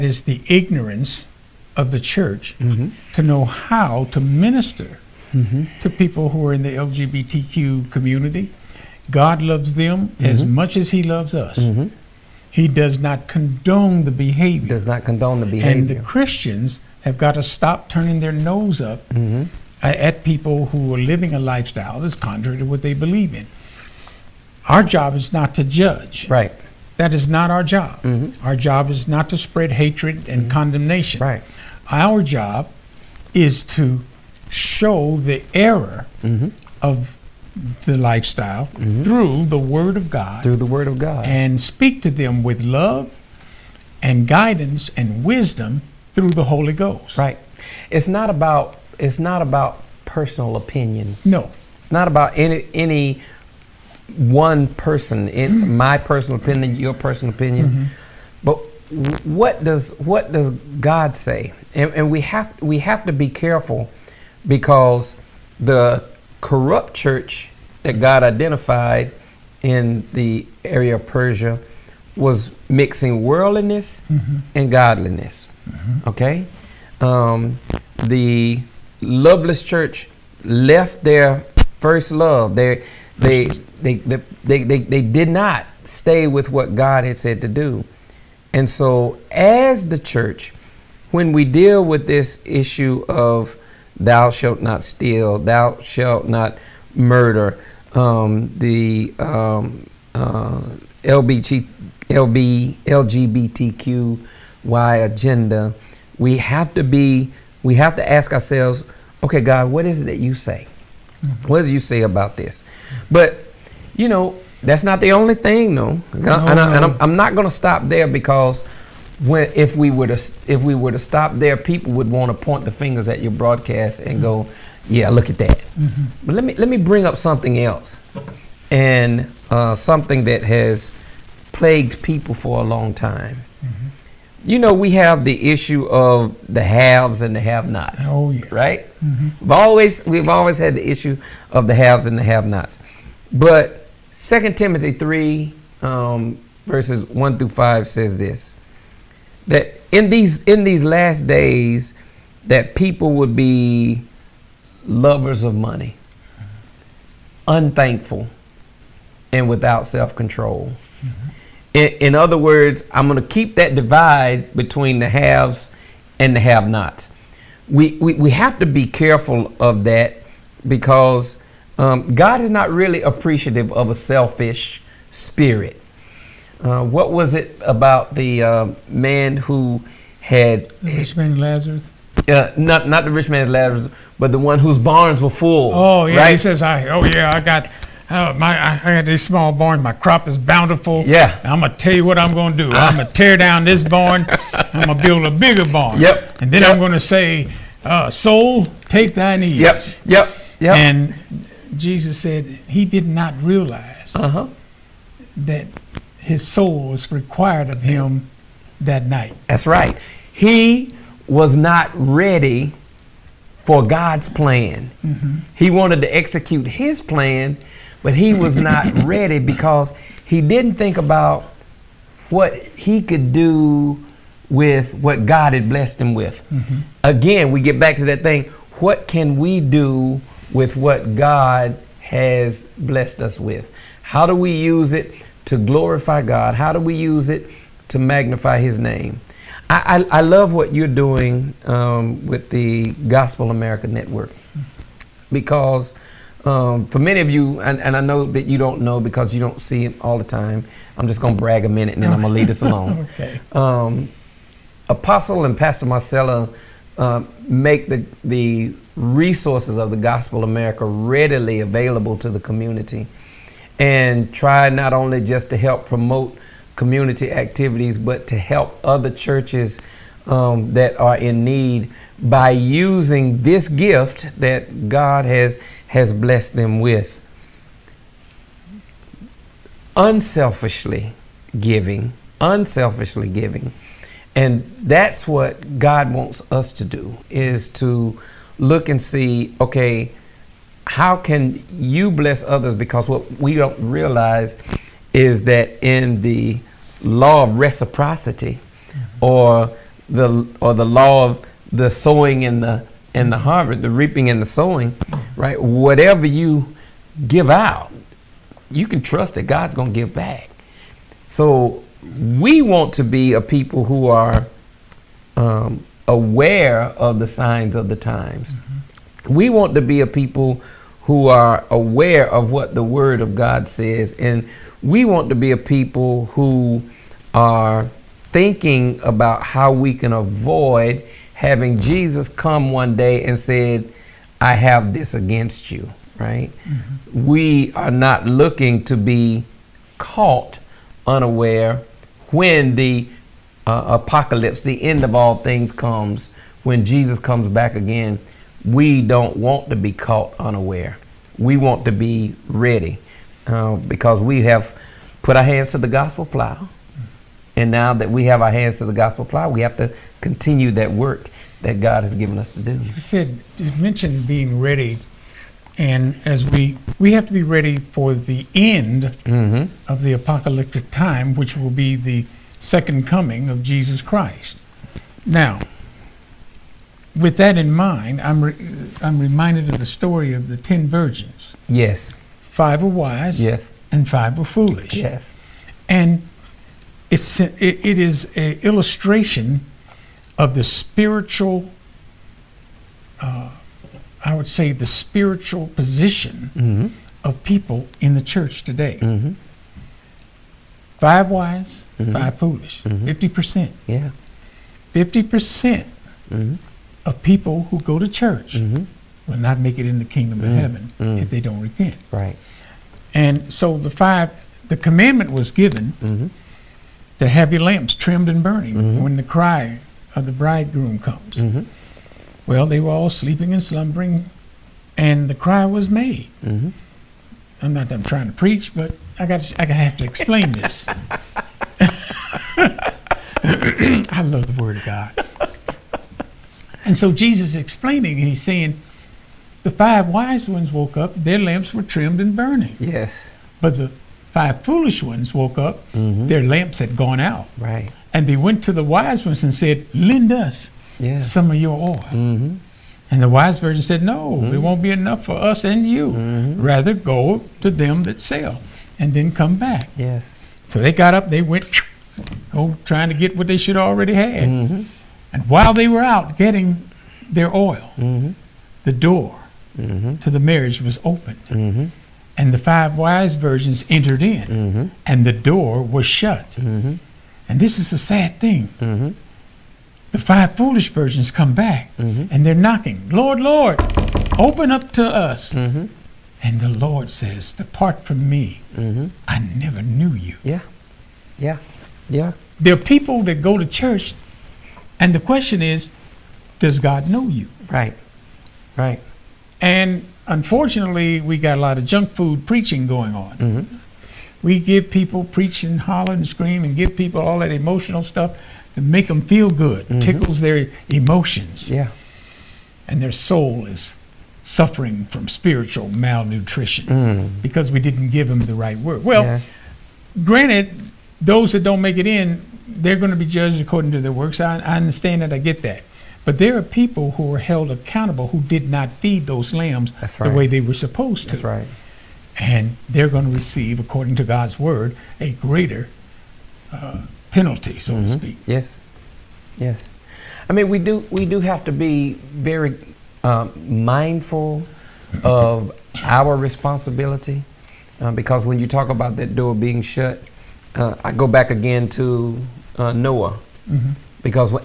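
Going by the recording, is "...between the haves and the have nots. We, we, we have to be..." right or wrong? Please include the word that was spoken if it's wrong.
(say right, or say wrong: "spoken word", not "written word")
right.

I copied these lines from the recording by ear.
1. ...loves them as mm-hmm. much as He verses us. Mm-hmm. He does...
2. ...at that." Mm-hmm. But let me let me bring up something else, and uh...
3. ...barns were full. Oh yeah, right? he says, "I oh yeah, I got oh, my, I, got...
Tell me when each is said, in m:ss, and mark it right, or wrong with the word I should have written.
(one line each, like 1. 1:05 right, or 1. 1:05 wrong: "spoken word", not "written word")
1. 0:09 wrong: "loves", not "verses"
2. 2:05 right
3. 3:04 right.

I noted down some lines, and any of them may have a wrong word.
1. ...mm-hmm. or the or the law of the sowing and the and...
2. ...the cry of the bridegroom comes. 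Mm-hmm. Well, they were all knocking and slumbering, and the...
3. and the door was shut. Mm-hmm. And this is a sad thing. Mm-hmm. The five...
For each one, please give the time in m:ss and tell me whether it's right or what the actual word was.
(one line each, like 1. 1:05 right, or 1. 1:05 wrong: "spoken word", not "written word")
1. 4:58 right
2. 6:59 wrong: "sleeping", not "knocking"
3. 7:55 right.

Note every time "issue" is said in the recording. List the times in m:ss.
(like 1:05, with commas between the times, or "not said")
1:32, 2:15, 2:20.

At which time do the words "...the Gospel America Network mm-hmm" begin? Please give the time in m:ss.
4:02.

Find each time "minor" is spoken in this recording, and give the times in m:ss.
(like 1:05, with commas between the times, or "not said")
not said.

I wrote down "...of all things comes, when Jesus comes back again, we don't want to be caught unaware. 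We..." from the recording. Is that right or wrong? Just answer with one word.
right.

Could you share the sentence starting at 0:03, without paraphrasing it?
to know how to minister mm-hmm.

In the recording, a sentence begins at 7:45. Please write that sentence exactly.
And while they were out getting their oil, mm-hmm.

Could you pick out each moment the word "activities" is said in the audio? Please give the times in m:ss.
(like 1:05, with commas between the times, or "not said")
4:27.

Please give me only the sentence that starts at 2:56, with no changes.
Uh, what was it about the uh, man who had the rich man Lazarus?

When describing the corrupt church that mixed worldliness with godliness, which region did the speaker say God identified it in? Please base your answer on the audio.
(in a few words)
Persia.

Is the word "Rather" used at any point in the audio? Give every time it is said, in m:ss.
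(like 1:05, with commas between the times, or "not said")
7:36.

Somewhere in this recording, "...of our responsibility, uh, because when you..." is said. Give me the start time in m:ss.
9:05.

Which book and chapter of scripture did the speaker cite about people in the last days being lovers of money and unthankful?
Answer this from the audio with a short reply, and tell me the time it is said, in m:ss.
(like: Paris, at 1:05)
Second Timothy 3, at 2:24.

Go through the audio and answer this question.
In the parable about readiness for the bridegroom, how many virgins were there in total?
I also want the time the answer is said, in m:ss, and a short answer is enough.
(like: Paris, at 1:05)
10, at 6:20.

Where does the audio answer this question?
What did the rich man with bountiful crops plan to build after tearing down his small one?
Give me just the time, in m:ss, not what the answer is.
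3:15.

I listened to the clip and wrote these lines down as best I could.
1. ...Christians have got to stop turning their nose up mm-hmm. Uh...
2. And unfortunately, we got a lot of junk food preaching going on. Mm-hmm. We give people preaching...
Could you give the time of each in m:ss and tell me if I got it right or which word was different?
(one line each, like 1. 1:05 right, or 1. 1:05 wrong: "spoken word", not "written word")
1. 0:15 right
2. 8:19 right.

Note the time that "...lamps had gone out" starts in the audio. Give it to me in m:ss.
7:26.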